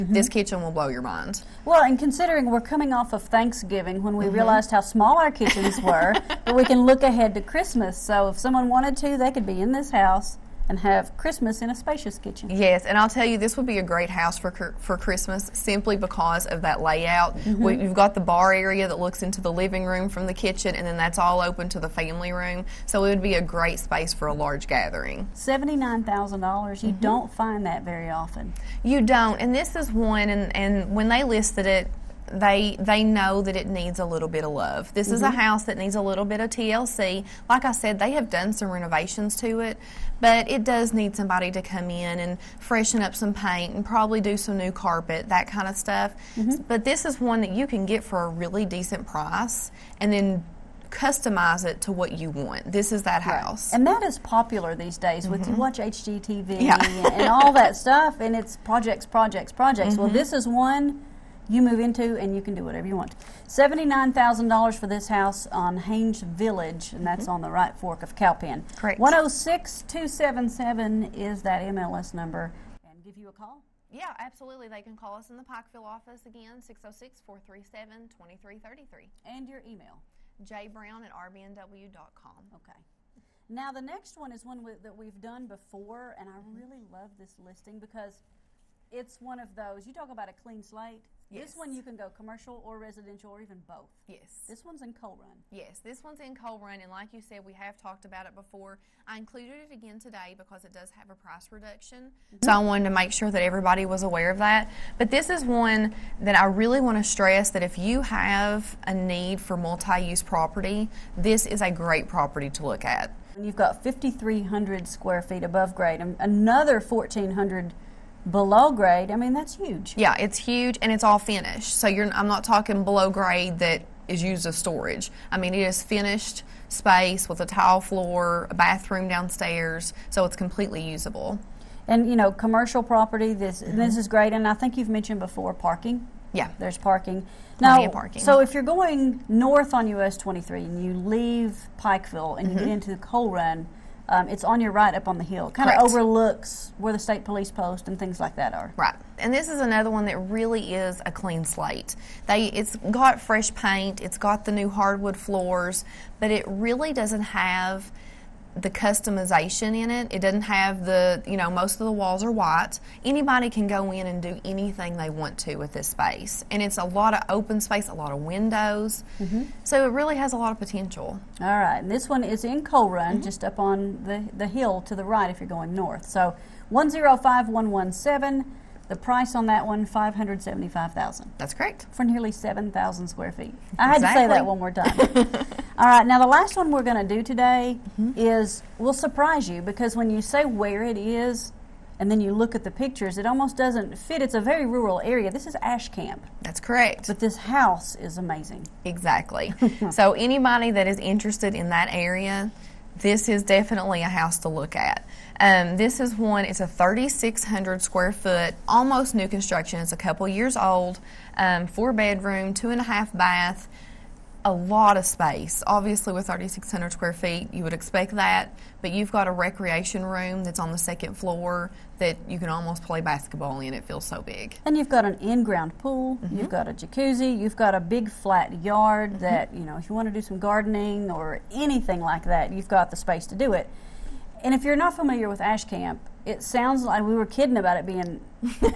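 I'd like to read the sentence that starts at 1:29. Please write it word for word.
You talk about a clean slate.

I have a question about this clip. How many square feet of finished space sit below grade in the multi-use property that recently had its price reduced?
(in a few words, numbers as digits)
1,400.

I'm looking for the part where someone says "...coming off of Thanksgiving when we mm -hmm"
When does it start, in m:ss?
0:02.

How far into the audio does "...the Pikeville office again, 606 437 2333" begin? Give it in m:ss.
1:15.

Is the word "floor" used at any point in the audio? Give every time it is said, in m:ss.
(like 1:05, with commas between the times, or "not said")
2:07, 2:35, 3:41.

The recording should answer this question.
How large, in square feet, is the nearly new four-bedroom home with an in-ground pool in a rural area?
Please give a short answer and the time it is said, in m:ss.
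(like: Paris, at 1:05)
3,600, at 3:26.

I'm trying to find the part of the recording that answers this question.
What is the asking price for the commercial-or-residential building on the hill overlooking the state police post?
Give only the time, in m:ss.
2:59.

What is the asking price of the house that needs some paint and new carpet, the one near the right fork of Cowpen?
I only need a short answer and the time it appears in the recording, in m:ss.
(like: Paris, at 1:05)
$79,000, at 0:25.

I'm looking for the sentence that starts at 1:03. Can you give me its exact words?
$79,000 for this house on Haines Village, and that's mm -hmm.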